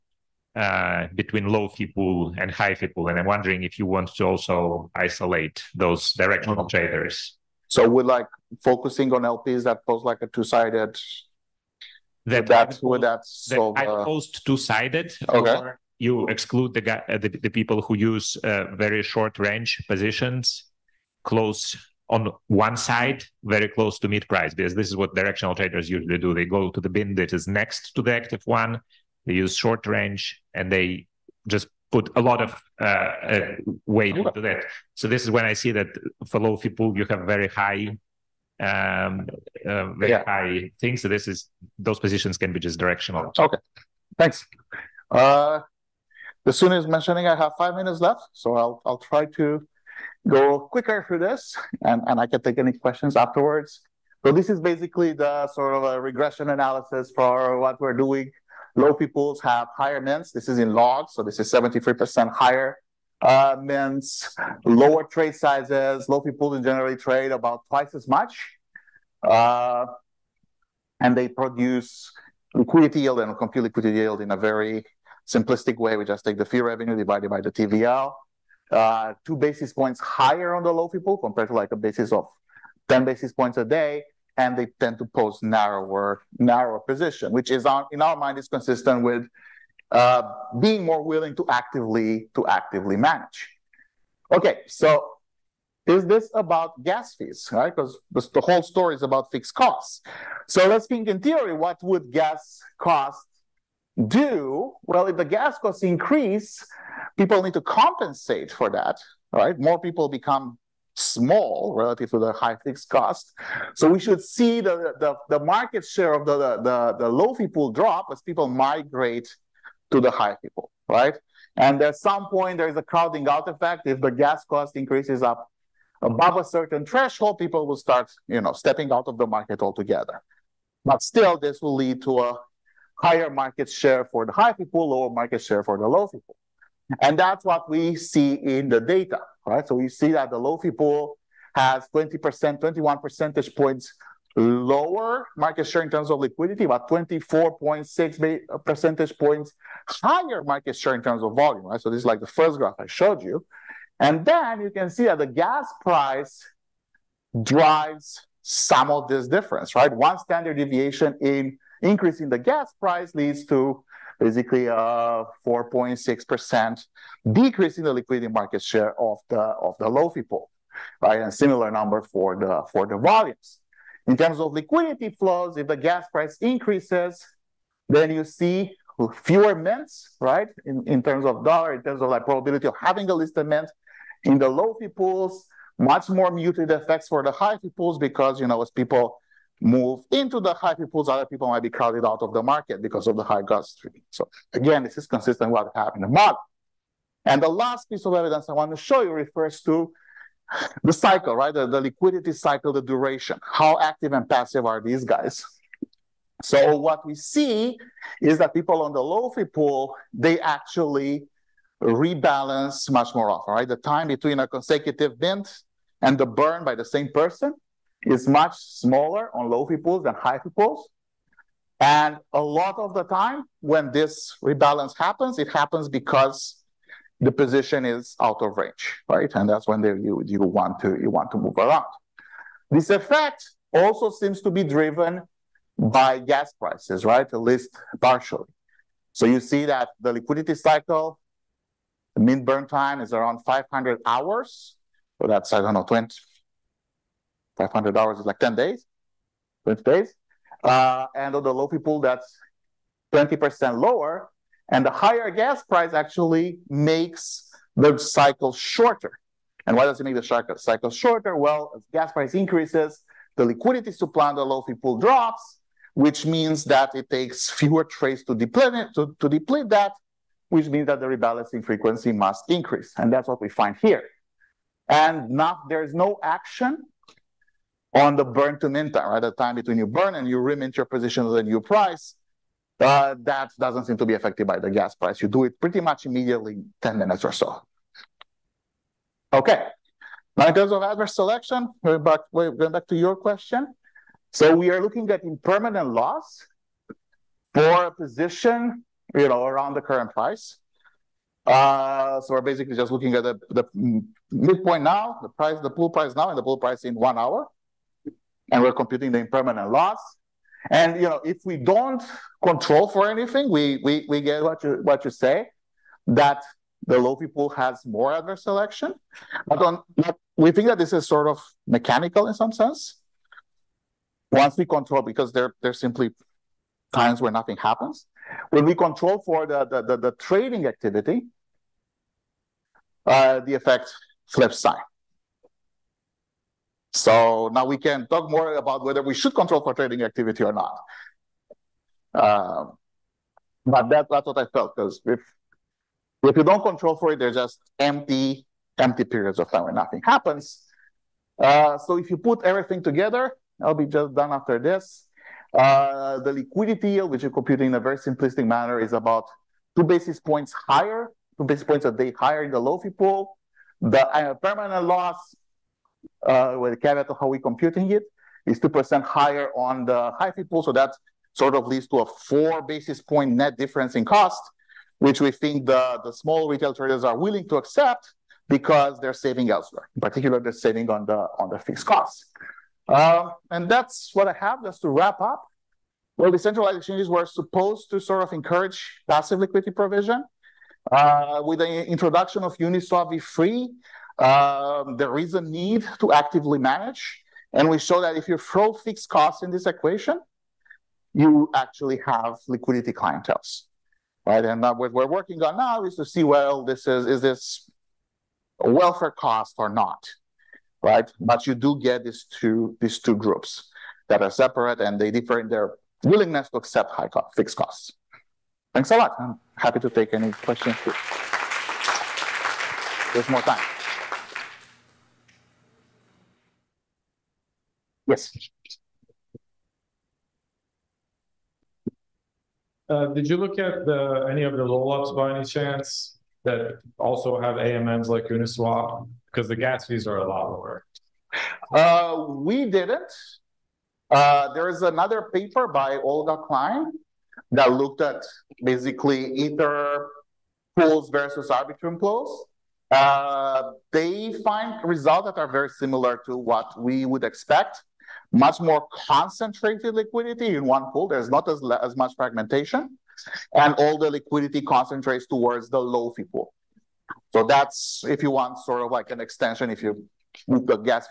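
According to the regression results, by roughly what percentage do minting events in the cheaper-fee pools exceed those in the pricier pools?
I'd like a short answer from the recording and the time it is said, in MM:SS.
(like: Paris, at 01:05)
73%, at 01:01.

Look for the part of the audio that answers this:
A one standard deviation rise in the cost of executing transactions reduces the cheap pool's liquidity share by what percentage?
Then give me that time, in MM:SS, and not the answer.
02:45.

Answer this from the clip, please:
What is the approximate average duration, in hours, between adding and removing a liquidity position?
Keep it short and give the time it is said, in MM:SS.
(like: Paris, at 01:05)
500 hours, at 04:03.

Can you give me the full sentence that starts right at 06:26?
Well, decentralized exchanges were supposed to sort of encourage passive liquidity provision.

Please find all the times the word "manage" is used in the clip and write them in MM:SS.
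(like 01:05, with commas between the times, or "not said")
01:32, 06:36.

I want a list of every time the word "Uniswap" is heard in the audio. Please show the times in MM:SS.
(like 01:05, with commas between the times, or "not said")
06:32, 07:18.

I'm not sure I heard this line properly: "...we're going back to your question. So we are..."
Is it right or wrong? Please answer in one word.
right.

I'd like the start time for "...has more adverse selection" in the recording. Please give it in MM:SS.
05:17.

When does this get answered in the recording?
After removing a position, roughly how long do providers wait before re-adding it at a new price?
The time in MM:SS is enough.
04:46.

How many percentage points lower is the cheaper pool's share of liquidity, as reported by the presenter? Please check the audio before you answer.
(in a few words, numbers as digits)
21 percentage points.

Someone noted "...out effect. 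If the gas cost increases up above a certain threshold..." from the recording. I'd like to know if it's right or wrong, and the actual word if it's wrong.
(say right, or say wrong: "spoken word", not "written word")
right.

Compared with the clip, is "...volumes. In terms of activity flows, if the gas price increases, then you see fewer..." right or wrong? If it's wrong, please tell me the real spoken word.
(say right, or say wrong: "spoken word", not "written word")
wrong: "liquidity", not "activity".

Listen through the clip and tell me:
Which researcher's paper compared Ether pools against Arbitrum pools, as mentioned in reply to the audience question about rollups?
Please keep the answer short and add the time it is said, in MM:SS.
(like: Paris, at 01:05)
Olga Klein, at 07:25.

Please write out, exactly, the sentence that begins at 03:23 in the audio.
How active and passive are these guys?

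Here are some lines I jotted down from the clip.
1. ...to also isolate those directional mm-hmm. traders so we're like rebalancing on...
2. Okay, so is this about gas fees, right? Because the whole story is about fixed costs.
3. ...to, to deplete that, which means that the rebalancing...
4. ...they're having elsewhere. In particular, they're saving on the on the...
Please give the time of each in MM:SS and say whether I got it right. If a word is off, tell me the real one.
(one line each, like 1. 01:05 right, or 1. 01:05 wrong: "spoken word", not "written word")
1. 00:04 wrong: "focusing", not "rebalancing"
2. 01:34 right
3. 04:28 right
4. 06:18 wrong: "saving", not "having".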